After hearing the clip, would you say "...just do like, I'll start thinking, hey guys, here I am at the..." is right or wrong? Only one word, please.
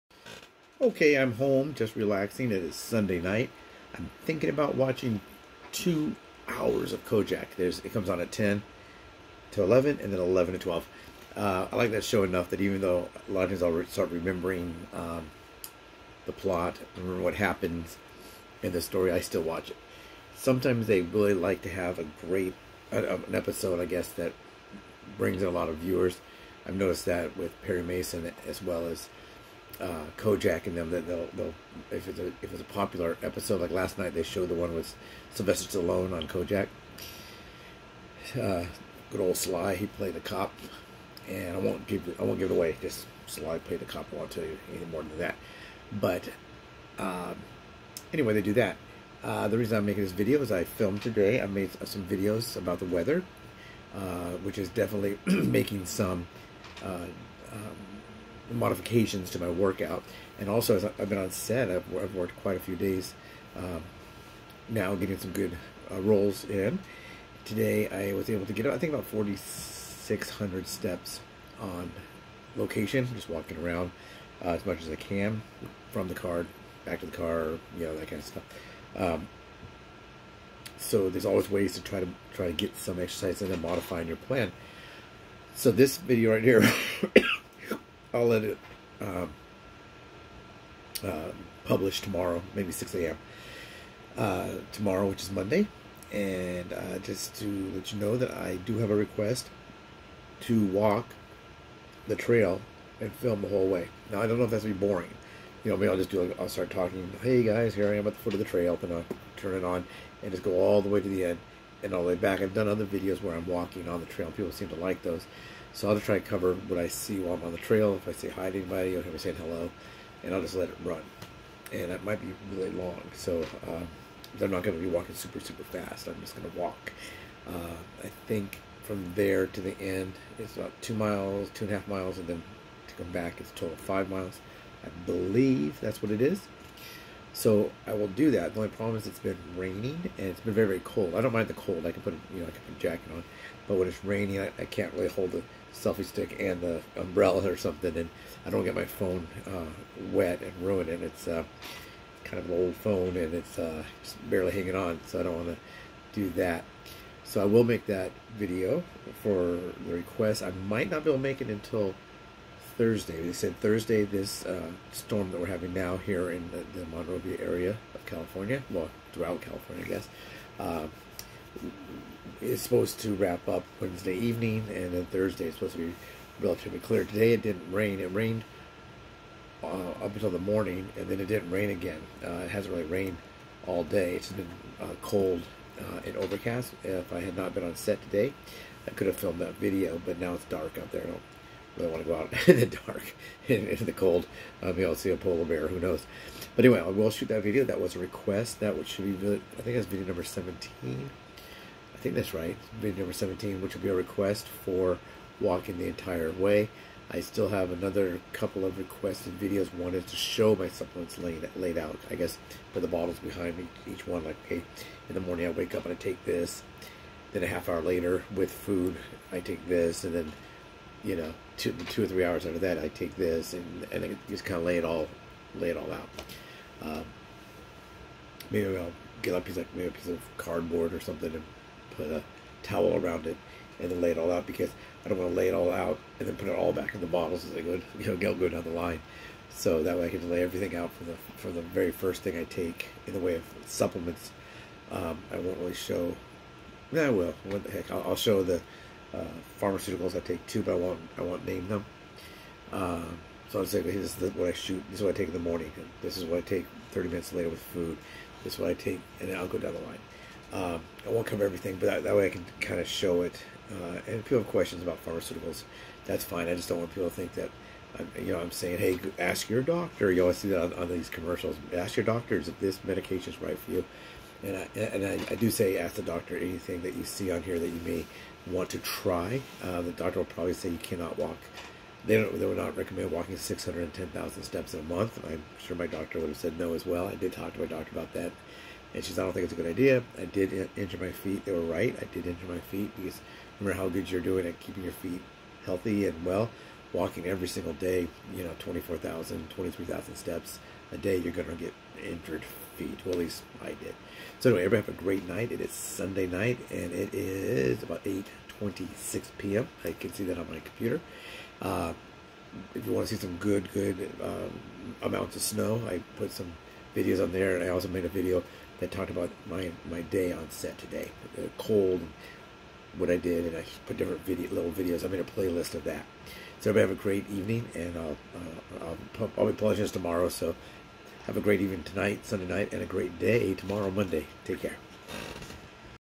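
wrong.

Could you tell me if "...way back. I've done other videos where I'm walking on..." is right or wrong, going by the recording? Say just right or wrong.
right.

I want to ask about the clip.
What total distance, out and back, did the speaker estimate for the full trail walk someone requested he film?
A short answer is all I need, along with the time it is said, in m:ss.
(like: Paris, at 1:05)
5 miles, at 2:13.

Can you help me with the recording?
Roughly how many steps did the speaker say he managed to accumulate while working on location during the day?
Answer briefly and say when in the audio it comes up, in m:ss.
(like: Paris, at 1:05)
4,600, at 1:09.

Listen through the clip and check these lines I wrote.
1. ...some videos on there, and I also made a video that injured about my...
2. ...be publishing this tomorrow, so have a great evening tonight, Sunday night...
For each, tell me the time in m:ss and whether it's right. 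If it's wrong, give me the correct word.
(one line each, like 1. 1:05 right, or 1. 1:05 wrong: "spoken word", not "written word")
1. 5:16 wrong: "talked", not "injured"
2. 5:29 right.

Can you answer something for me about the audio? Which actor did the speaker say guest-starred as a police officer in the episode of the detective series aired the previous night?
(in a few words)
Sylvester Stallone.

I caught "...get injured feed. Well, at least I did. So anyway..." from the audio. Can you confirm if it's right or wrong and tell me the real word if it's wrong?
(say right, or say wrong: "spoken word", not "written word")
right.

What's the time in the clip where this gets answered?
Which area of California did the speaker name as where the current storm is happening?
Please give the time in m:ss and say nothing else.
2:46.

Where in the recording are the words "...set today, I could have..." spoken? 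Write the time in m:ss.
3:07.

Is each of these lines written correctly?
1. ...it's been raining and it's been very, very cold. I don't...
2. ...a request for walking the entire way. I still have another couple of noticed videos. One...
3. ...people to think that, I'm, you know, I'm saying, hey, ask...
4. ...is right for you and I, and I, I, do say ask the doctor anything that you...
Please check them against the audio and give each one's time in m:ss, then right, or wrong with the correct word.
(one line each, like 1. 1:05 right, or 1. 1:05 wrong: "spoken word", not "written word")
1. 2:19 right
2. 3:23 wrong: "requested", not "noticed"
3. 4:26 right
4. 4:33 right.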